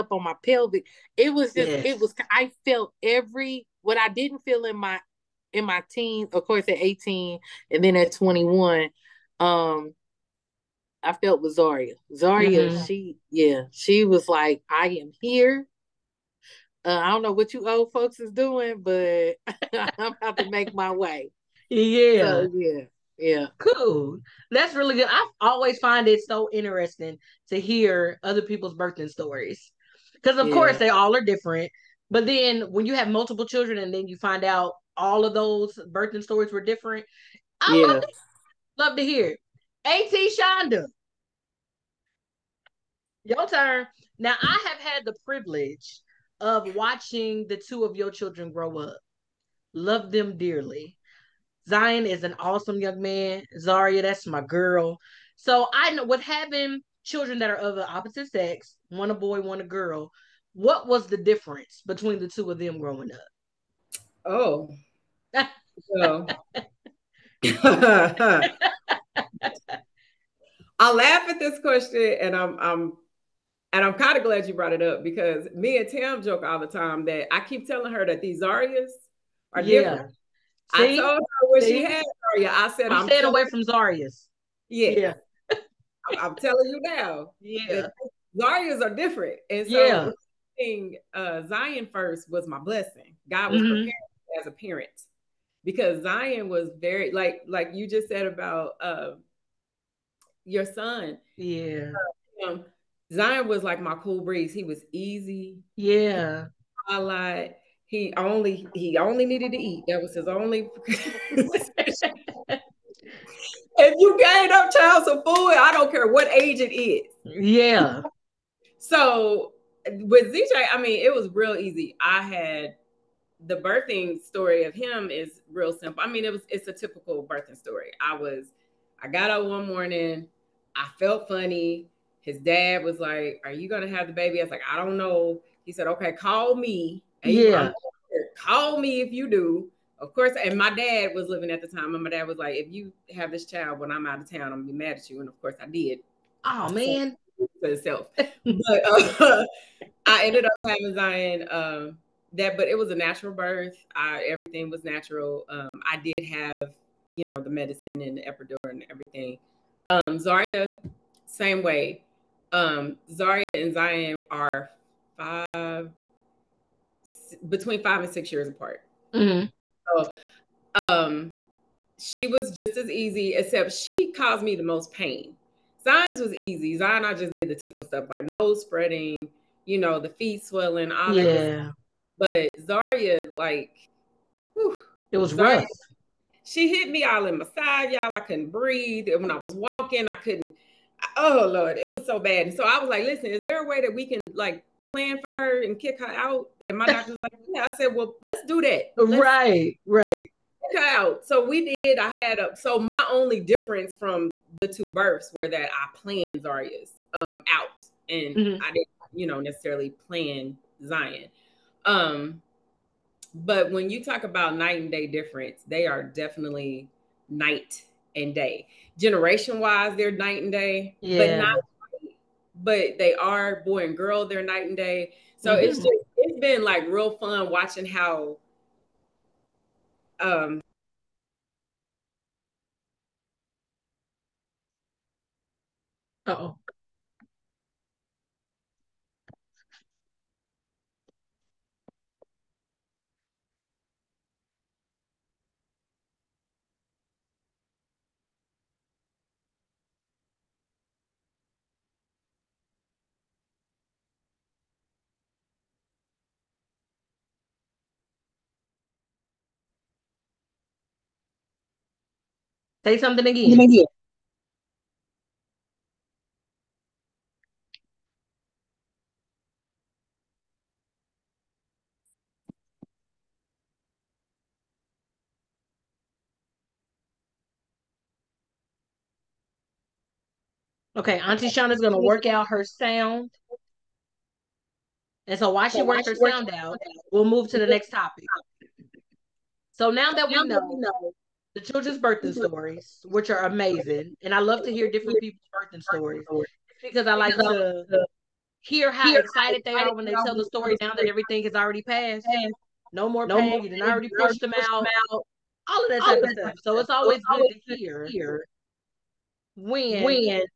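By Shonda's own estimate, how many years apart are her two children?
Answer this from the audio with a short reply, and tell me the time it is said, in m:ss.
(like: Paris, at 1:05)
5 to 6, at 2:47.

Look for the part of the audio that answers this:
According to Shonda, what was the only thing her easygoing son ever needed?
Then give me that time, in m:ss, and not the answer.
1:48.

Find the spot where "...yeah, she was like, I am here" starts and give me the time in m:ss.
0:13.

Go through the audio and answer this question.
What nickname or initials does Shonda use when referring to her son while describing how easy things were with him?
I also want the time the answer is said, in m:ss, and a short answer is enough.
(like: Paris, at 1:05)
ZJ, at 2:00.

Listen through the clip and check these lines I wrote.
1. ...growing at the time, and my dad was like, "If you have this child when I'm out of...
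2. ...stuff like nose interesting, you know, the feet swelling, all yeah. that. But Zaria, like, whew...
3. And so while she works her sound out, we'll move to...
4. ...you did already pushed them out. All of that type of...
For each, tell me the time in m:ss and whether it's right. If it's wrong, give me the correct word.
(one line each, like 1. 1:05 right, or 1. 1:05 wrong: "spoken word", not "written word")
1. 2:21 wrong: "living", not "growing"
2. 2:57 wrong: "spreading", not "interesting"
3. 4:45 right
4. 5:03 right.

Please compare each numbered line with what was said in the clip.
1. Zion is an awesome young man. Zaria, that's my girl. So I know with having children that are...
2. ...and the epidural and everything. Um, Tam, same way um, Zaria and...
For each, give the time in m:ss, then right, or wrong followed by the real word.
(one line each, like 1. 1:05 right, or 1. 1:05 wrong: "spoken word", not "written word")
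1. 0:51 right
2. 2:38 wrong: "Zaria", not "Tam".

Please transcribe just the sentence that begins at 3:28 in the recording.
I didn't, you know, necessarily plan Zion.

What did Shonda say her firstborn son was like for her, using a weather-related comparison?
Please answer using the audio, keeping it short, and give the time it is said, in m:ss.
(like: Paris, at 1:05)
cool breeze, at 1:43.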